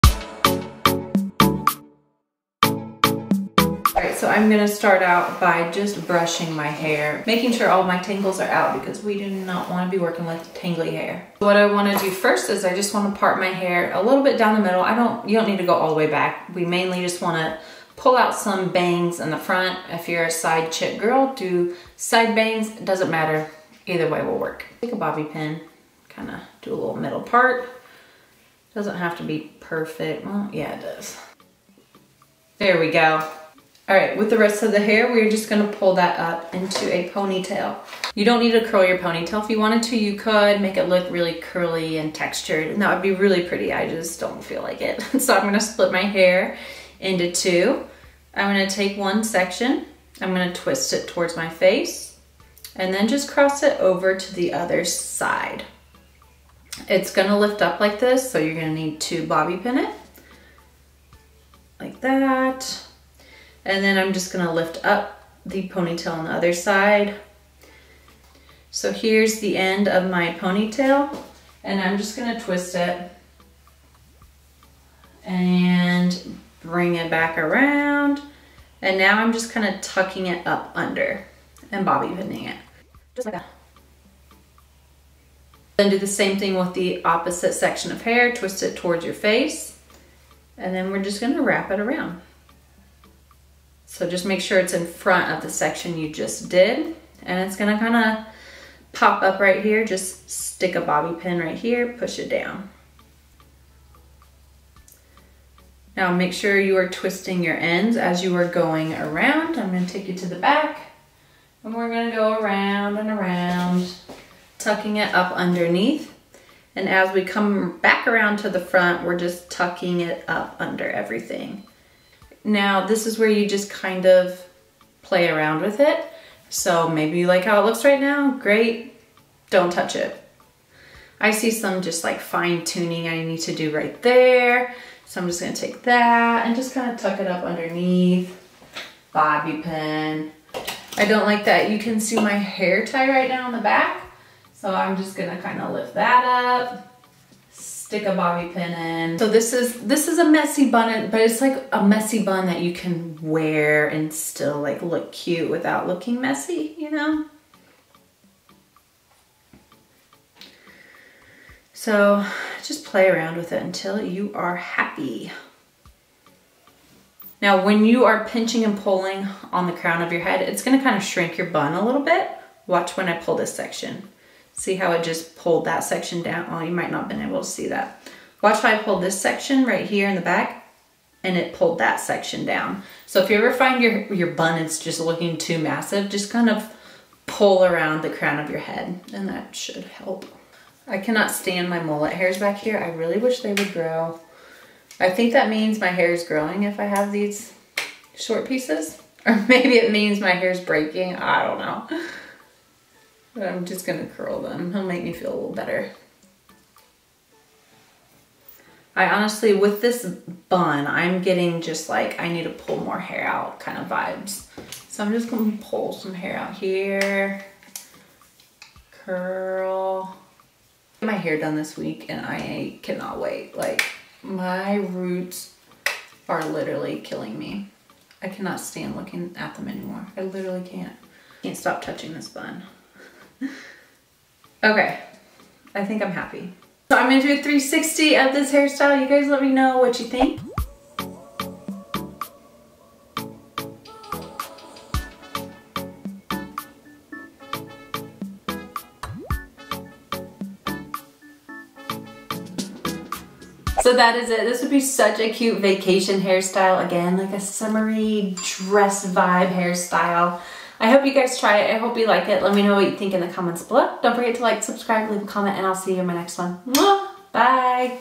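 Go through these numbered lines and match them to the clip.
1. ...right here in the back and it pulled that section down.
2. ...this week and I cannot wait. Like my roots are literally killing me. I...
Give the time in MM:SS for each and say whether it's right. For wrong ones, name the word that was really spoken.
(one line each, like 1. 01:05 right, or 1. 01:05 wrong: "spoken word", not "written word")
1. 02:59 right
2. 03:41 right.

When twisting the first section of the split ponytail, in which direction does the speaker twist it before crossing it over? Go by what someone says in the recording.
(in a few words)
towards my face.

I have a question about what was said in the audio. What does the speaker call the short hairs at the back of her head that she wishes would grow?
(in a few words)
mullet hairs.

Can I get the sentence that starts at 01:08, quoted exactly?
So here's the end of my ponytail and I'm just gonna twist it and bring it back around.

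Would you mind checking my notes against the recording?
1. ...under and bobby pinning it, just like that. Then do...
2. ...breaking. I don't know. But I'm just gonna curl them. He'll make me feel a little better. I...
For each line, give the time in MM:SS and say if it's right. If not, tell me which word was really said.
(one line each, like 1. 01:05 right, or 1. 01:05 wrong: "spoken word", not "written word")
1. 01:20 right
2. 03:20 right.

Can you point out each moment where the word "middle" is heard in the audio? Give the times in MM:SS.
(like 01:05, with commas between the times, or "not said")
00:14, 00:26.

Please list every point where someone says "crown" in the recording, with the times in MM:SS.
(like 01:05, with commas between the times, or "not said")
02:49, 03:08.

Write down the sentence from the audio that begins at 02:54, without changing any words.
See how it just pulled that section down?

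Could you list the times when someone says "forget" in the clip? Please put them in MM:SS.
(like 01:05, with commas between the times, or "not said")
04:24.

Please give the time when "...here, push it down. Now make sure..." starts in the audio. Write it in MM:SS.
01:41.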